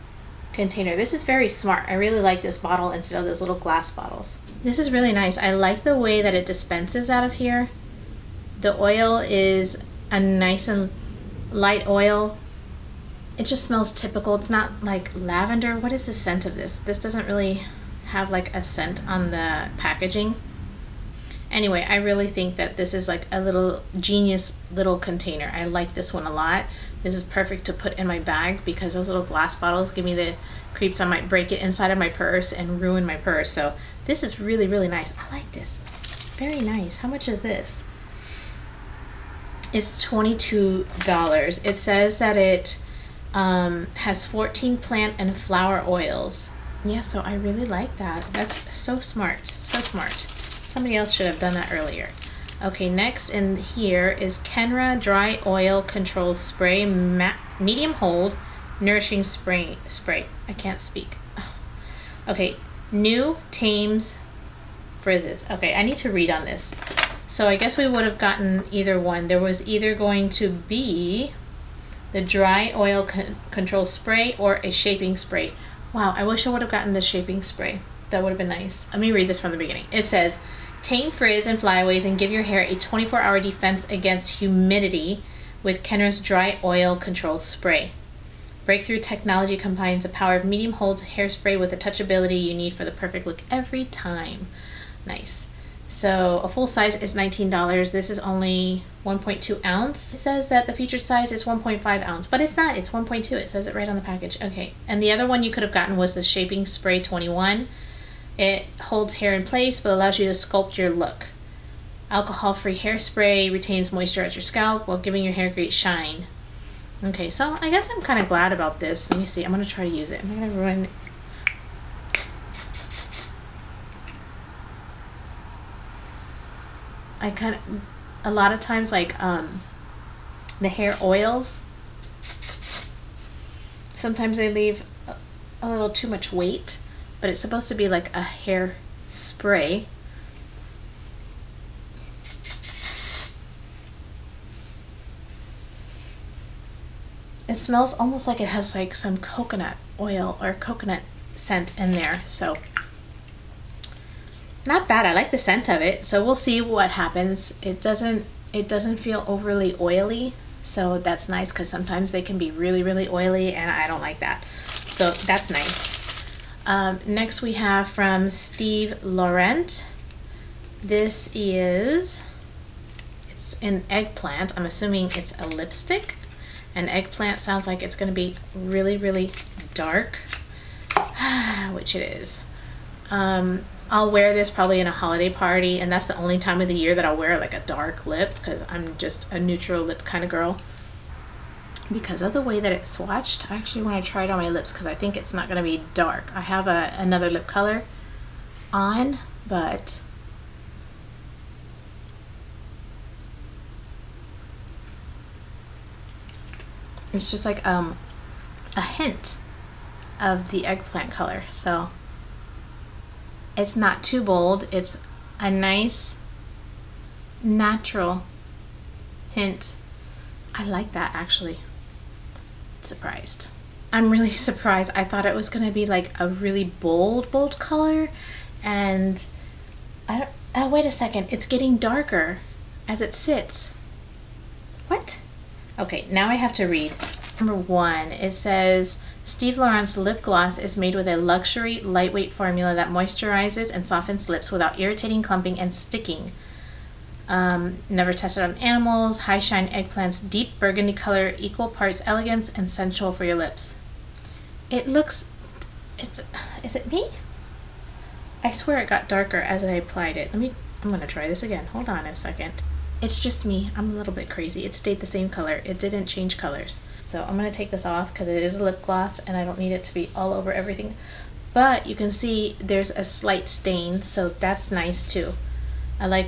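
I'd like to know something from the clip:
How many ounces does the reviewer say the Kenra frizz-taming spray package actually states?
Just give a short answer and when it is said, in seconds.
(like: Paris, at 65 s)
1.2 ounces, at 102 s.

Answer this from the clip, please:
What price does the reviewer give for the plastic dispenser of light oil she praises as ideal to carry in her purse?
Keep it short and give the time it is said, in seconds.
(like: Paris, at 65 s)
$22, at 39 s.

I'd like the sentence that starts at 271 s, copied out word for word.
But you can see there's a slight stain, so that's nice too.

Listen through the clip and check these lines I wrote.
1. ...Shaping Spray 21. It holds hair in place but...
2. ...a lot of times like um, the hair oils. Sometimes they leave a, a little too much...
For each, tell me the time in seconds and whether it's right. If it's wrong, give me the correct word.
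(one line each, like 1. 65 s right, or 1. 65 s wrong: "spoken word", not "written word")
1. 106 s right
2. 128 s right.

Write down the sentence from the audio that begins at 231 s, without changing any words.
It's getting darker as it sits.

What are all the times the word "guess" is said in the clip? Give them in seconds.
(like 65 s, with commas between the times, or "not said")
67 s, 117 s.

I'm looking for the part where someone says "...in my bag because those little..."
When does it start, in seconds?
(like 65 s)
27 s.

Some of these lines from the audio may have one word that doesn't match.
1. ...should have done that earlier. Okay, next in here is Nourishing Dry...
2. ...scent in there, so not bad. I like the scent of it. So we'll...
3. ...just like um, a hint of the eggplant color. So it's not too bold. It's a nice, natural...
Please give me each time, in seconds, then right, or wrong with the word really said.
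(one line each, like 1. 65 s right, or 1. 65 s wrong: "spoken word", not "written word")
1. 51 s wrong: "Kenra", not "Nourishing"
2. 151 s right
3. 207 s right.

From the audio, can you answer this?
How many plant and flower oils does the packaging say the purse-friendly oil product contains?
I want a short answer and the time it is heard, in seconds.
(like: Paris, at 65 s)
14, at 44 s.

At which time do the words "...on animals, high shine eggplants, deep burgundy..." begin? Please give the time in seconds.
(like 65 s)
248 s.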